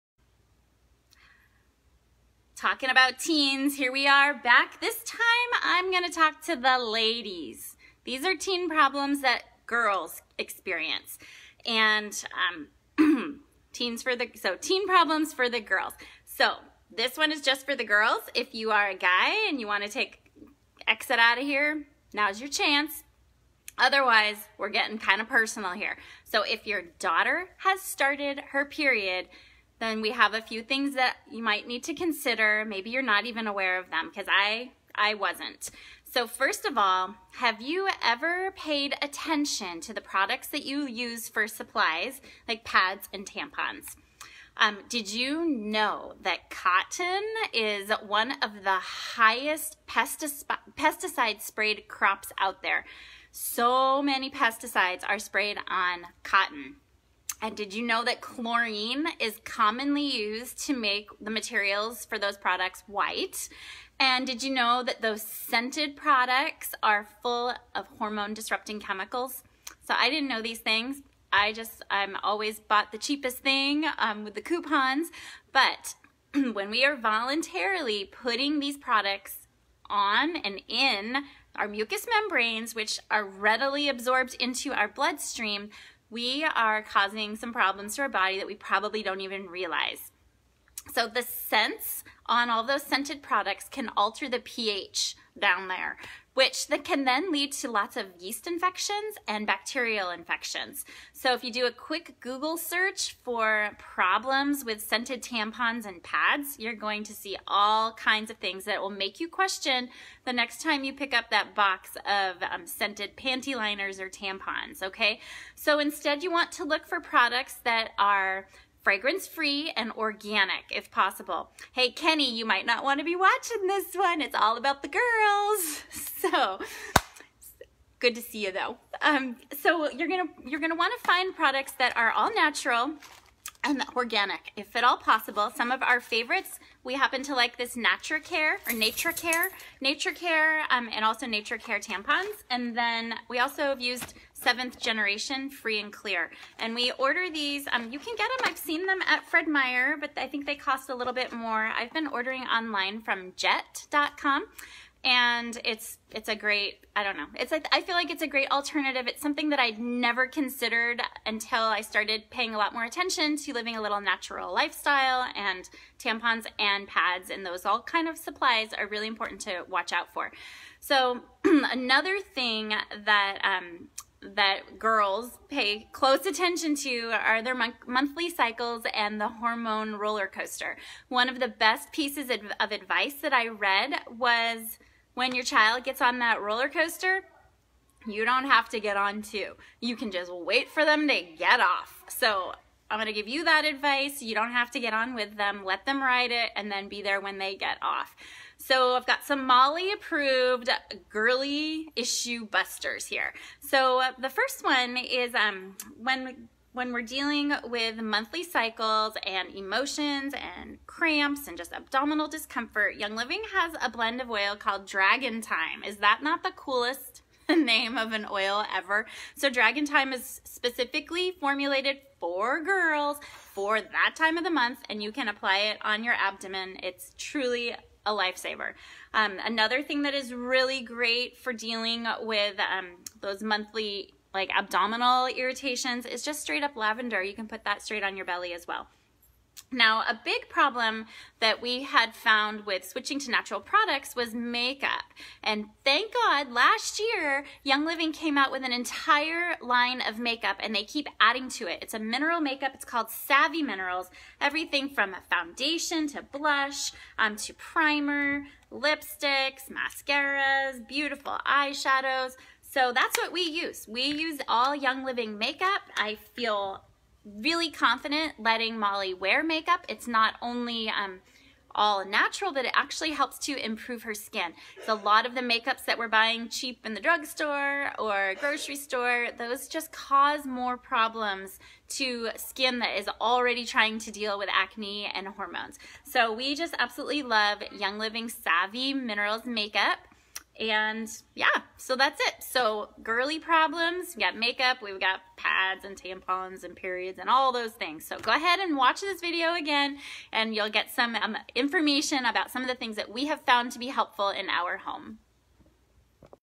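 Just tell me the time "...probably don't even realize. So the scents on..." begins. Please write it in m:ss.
1:28.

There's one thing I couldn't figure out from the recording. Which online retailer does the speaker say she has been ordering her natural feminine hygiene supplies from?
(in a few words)
jet.com.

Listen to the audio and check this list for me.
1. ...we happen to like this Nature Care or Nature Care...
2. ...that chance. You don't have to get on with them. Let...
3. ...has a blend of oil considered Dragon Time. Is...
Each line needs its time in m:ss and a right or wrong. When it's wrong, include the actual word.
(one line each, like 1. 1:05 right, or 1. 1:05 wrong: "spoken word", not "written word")
1. 2:16 right
2. 3:13 wrong: "advice", not "chance"
3. 3:33 wrong: "called", not "considered".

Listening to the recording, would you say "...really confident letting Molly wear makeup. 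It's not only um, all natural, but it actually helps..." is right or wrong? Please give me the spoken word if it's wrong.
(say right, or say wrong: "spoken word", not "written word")
right.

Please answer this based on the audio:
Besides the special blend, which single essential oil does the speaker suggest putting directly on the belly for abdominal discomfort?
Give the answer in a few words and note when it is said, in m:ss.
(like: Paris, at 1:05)
lavender, at 3:56.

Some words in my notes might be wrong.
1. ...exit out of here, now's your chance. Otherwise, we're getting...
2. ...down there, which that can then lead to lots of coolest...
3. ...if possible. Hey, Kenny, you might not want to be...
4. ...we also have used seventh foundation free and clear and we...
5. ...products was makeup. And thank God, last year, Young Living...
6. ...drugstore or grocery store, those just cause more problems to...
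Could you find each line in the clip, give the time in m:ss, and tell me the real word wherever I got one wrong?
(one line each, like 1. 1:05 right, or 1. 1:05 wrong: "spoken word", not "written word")
1. 0:20 right
2. 1:35 wrong: "yeast", not "coolest"
3. 2:00 right
4. 2:23 wrong: "generation", not "foundation"
5. 4:03 right
6. 4:36 right.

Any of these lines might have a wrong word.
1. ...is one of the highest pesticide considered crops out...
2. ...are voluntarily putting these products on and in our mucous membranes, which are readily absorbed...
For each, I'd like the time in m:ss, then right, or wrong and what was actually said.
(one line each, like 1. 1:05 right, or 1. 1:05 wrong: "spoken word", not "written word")
1. 0:47 wrong: "sprayed", not "considered"
2. 1:16 right.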